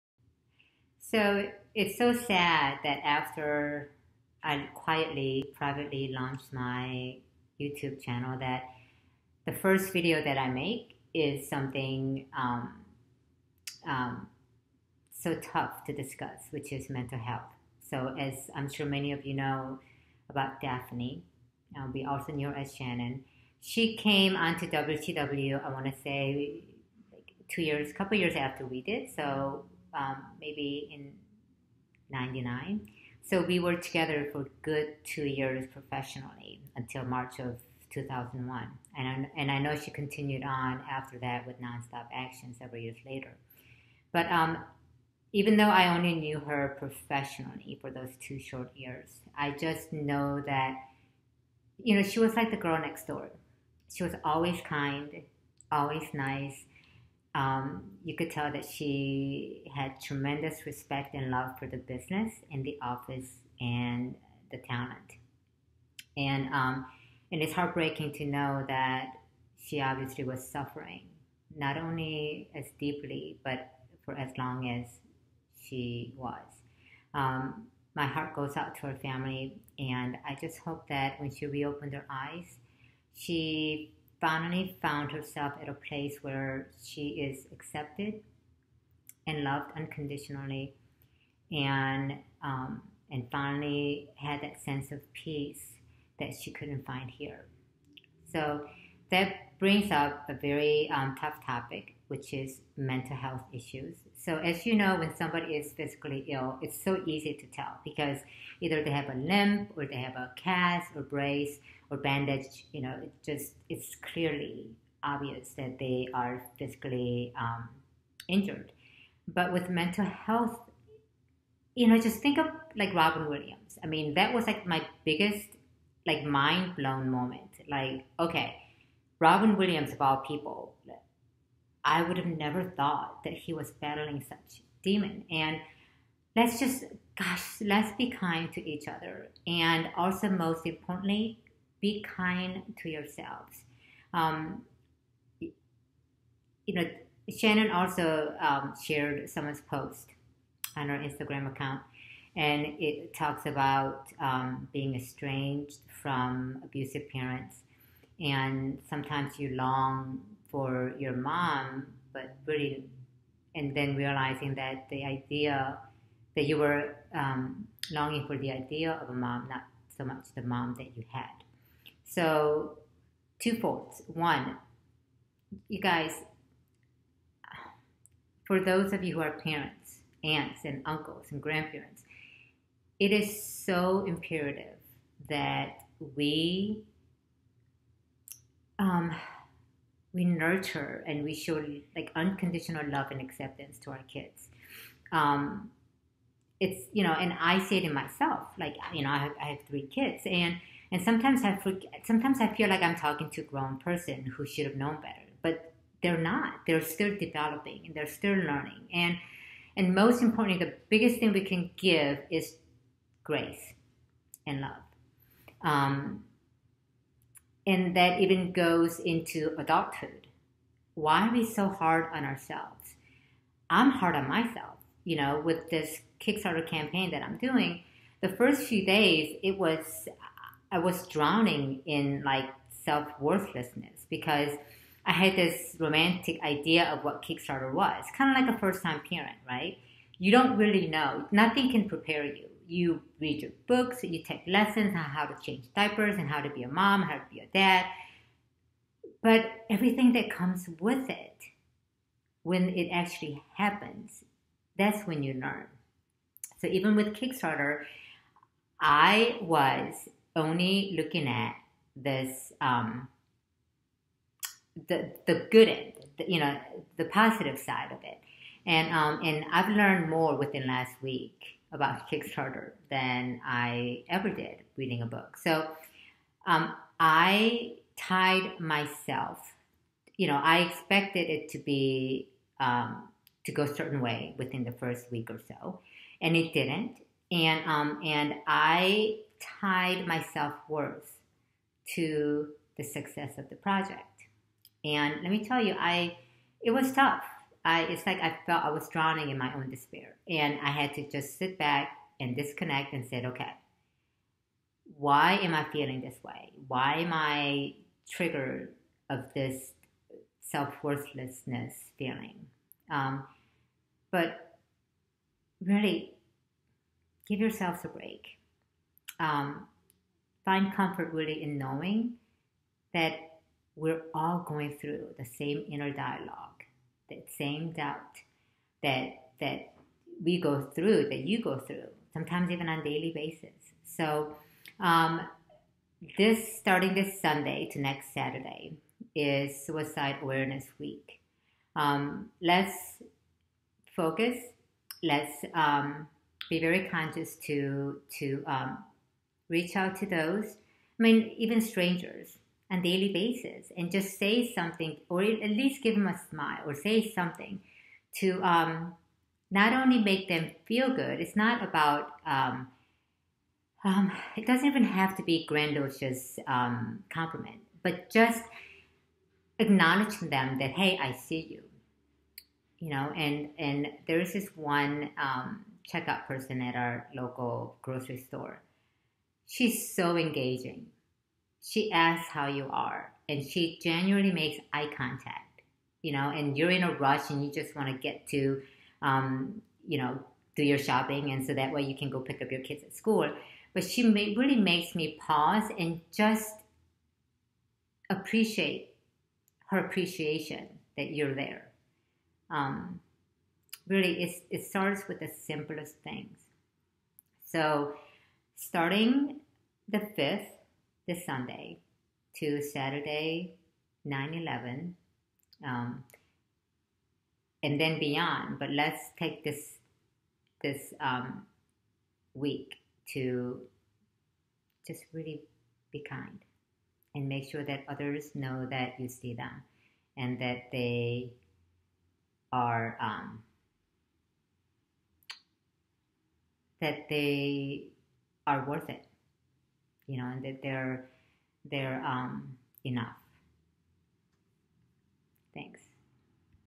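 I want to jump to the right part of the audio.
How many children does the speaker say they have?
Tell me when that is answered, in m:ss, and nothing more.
3:19.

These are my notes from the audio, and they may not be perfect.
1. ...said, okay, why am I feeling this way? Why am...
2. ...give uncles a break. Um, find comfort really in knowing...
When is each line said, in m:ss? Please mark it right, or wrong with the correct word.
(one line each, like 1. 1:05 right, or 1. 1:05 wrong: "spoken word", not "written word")
1. 5:03 right
2. 5:17 wrong: "yourselves", not "uncles".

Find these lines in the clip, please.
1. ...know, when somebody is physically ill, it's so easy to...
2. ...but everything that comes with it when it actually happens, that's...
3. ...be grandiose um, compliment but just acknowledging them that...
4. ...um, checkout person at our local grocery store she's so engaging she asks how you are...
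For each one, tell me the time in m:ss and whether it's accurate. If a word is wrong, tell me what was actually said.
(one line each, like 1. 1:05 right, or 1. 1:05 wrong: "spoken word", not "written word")
1. 1:44 right
2. 4:09 right
3. 6:05 right
4. 6:15 right.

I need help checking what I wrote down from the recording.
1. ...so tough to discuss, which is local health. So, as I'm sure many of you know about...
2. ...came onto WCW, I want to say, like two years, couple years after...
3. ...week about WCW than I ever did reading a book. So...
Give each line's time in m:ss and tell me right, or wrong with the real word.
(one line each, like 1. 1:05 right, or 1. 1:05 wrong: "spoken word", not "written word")
1. 0:15 wrong: "mental", not "local"
2. 0:23 right
3. 4:31 wrong: "Kickstarter", not "WCW".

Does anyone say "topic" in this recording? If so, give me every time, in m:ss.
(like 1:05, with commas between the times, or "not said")
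1:41.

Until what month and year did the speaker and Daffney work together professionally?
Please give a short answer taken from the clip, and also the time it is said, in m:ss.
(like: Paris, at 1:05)
March 2001, at 0:37.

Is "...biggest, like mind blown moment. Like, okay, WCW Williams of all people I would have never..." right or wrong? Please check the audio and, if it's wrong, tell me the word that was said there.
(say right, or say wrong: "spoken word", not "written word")
wrong: "Robin", not "WCW".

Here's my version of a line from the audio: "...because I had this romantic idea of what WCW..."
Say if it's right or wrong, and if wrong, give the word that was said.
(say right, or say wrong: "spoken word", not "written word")
wrong: "Kickstarter", not "WCW".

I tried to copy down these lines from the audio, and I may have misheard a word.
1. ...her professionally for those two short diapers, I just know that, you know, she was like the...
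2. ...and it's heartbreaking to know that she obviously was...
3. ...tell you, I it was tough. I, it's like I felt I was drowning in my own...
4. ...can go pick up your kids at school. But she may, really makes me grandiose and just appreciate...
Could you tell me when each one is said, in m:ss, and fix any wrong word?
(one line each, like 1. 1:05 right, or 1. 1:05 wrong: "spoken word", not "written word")
1. 0:46 wrong: "years", not "diapers"
2. 1:07 right
3. 4:55 right
4. 6:31 wrong: "pause", not "grandiose".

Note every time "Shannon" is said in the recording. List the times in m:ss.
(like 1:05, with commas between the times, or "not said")
0:22, 2:27.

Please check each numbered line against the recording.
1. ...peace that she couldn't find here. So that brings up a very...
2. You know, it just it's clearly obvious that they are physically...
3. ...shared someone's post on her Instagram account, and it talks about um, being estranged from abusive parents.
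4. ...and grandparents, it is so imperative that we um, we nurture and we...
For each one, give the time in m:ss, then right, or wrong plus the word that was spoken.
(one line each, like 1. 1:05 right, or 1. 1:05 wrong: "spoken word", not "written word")
1. 1:35 right
2. 1:52 right
3. 2:28 right
4. 3:01 right.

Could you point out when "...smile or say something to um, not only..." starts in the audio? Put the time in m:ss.
5:56.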